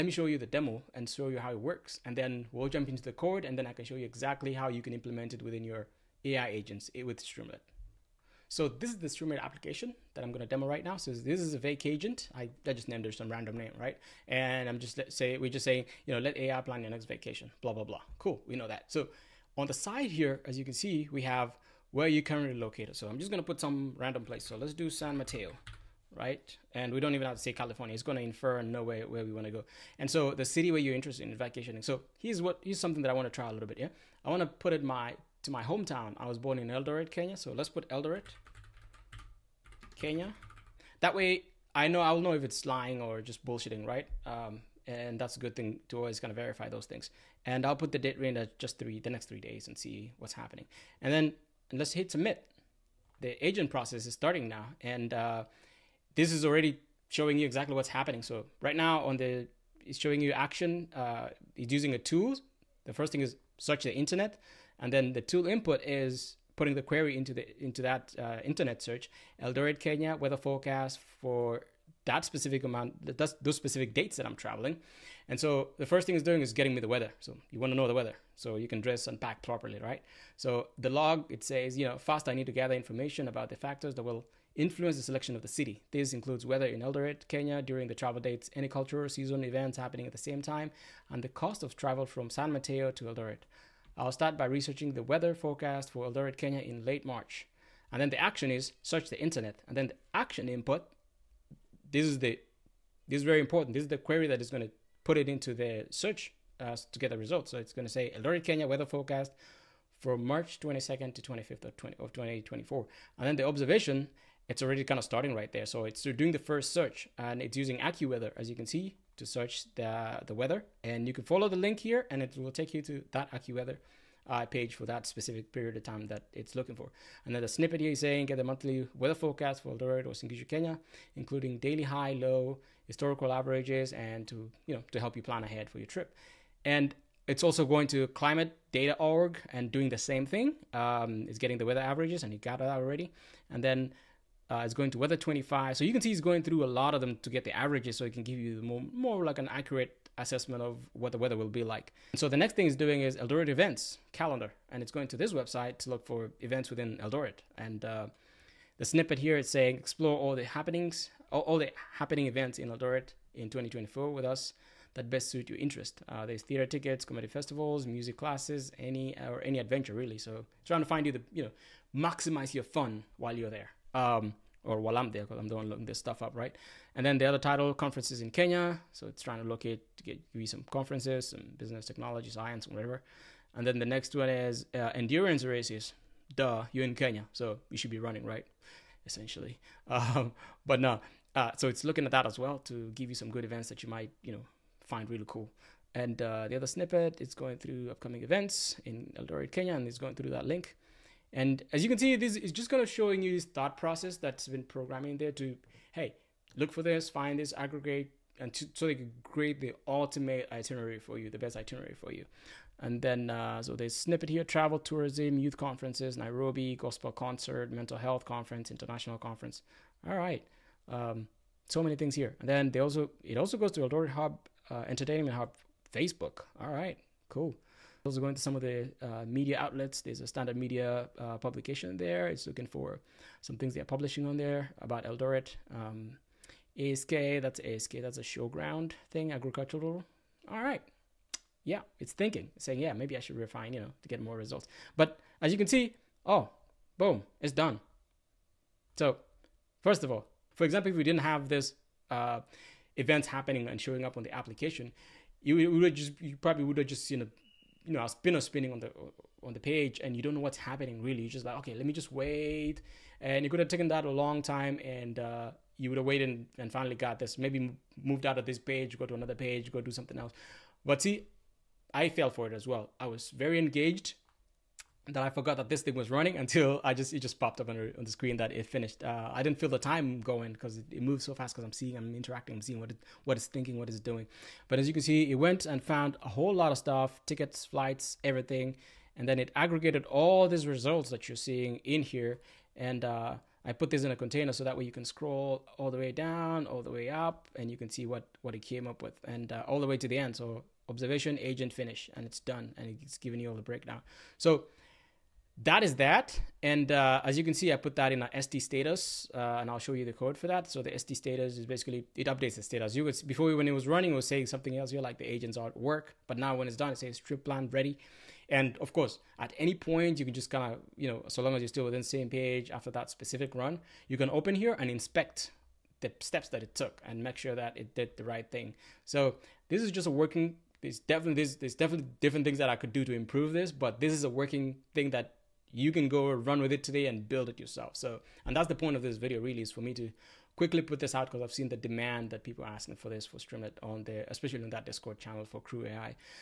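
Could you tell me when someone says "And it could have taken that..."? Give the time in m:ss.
4:23.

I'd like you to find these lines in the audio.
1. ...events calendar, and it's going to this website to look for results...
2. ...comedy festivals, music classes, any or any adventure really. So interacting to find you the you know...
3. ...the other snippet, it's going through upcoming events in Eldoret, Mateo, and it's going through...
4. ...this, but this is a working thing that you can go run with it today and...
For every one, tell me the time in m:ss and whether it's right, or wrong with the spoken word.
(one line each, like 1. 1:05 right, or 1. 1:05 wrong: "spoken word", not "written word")
1. 2:33 wrong: "events", not "results"
2. 2:47 wrong: "trying", not "interacting"
3. 3:16 wrong: "Kenya", not "Mateo"
4. 5:33 right.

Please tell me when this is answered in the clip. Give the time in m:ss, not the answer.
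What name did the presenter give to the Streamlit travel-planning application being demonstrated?
0:11.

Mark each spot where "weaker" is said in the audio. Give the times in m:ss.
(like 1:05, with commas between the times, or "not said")
not said.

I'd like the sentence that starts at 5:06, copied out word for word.
And uh, as you can see, I put that in a ST status, uh, and I'll show you the code for that.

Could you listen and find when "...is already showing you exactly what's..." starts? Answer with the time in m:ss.
0:56.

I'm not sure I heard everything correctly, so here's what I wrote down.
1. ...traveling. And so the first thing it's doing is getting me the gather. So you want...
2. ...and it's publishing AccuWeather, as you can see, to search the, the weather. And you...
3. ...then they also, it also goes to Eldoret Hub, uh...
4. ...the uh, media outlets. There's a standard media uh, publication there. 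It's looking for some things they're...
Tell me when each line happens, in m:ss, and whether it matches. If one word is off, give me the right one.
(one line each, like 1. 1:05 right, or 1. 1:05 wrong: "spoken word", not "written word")
1. 1:14 wrong: "weather", not "gather"
2. 1:57 wrong: "using", not "publishing"
3. 3:42 right
4. 3:48 right.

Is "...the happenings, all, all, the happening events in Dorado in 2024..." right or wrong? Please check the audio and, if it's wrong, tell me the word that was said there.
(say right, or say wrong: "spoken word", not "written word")
right.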